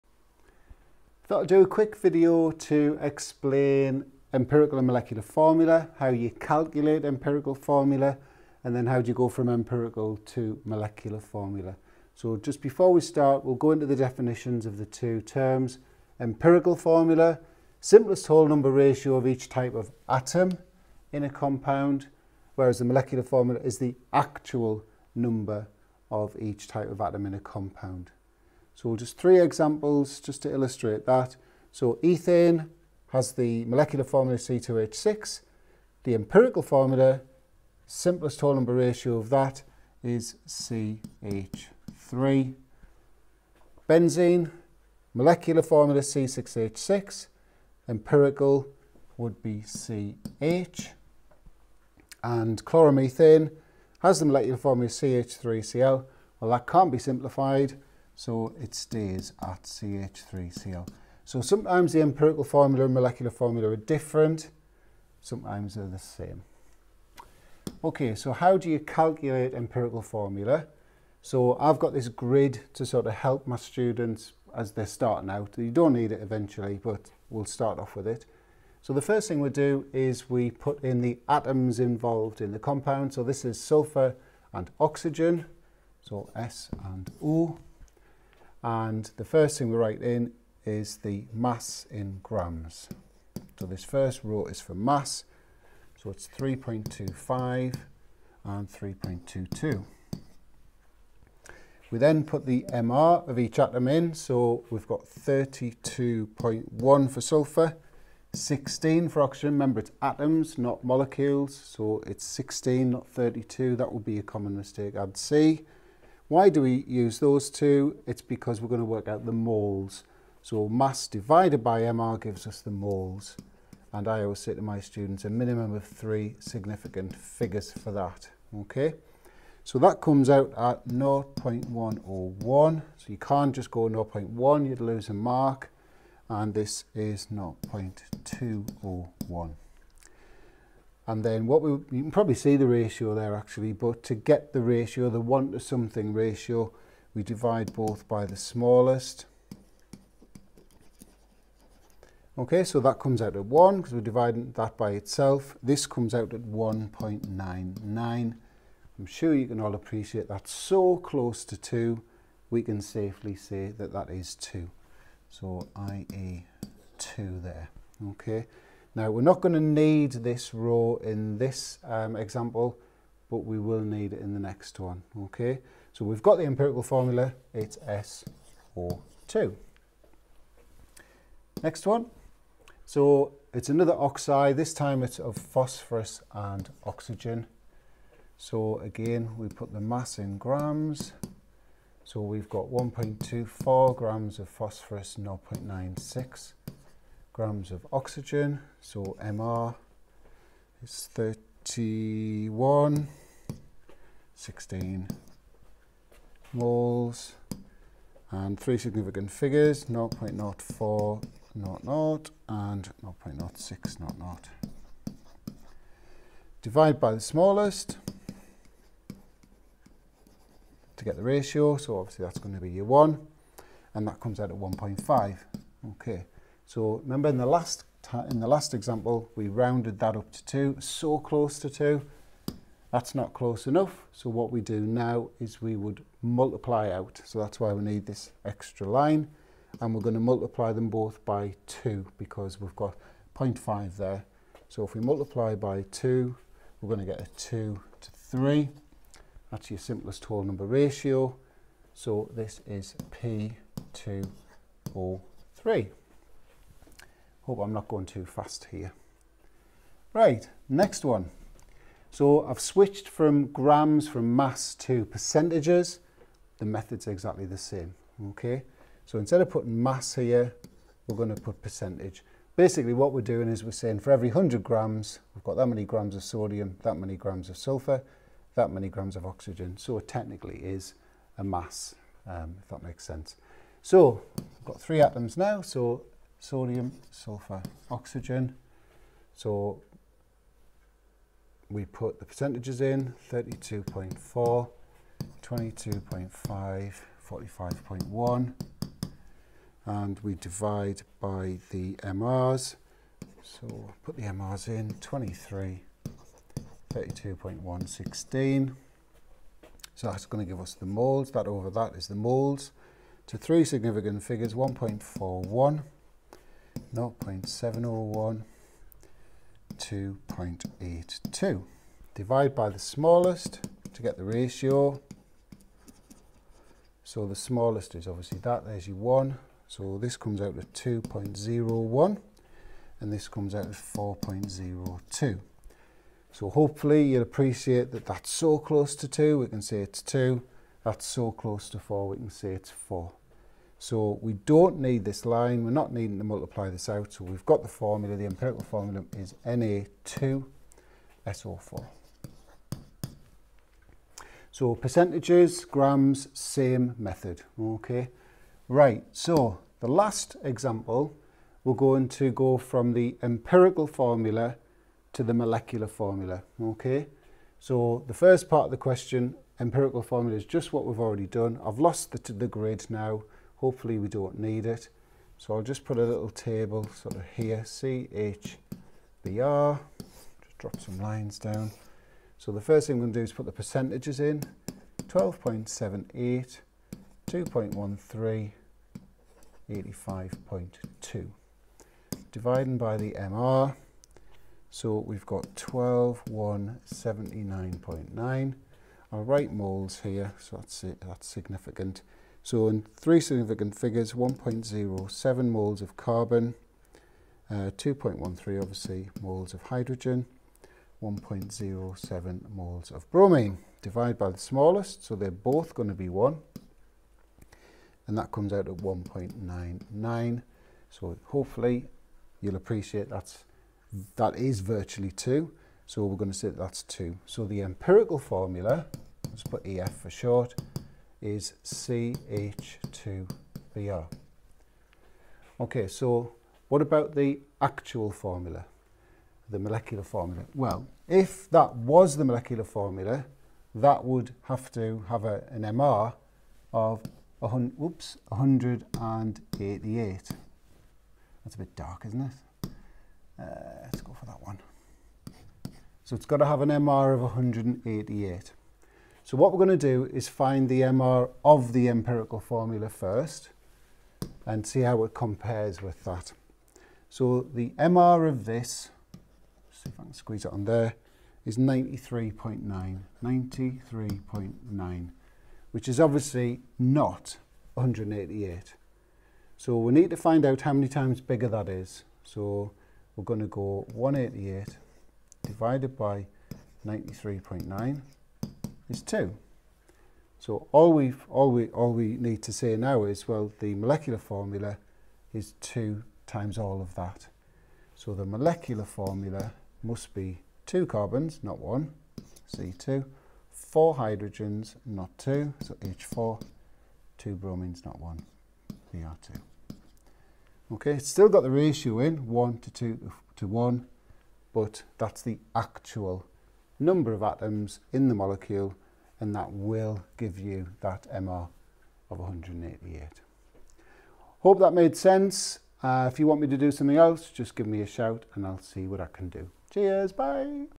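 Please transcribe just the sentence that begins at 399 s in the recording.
write moles here, so that's it, that's significant.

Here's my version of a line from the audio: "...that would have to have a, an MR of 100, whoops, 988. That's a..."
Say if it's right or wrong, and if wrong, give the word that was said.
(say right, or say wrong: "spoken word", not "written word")
wrong: "188", not "988".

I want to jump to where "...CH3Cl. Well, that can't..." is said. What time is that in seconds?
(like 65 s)
54 s.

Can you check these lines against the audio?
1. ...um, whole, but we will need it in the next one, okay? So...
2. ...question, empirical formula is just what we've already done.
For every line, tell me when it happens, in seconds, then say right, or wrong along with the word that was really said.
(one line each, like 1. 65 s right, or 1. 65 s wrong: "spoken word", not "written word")
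1. 171 s wrong: "example", not "whole"
2. 368 s right.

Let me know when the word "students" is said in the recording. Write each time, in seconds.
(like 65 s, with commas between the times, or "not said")
73 s, 124 s.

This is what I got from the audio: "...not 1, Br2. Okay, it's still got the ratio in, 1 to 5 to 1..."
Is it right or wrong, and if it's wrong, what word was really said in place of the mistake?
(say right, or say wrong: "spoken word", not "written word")
wrong: "2", not "5".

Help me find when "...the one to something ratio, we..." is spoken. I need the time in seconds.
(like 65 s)
145 s.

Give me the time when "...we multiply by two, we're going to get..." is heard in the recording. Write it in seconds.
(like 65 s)
244 s.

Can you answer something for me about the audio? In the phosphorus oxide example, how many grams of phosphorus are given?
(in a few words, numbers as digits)
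1.24 grams.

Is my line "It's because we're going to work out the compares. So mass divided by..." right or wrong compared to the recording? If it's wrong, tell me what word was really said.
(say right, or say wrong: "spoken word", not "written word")
wrong: "moles", not "compares".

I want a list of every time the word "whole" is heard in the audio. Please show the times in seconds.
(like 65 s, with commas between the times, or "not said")
18 s, 38 s, 250 s.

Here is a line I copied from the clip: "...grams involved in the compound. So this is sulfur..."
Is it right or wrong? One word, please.
wrong.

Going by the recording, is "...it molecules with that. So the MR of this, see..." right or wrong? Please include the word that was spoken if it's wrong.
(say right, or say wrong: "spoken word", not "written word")
wrong: "compares", not "molecules".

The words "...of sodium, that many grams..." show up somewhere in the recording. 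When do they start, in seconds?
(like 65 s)
276 s.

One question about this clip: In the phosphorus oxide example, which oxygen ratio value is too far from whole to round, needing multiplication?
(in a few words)
1.5.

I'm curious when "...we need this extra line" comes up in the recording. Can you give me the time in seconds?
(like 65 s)
237 s.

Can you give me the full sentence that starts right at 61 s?
So sometimes the empirical formula and molecular formula are different, sometimes they're the same.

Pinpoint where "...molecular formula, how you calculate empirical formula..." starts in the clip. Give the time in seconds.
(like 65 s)
4 s.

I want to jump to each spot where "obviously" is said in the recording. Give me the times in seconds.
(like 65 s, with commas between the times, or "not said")
221 s, 328 s, 408 s, 475 s.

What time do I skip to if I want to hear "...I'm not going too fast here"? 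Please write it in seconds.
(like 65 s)
257 s.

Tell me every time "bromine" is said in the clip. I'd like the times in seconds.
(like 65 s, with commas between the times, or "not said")
413 s, 507 s.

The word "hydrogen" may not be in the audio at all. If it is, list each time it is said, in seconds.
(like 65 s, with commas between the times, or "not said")
409 s, 503 s.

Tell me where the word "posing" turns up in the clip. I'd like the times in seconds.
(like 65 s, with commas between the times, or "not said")
not said.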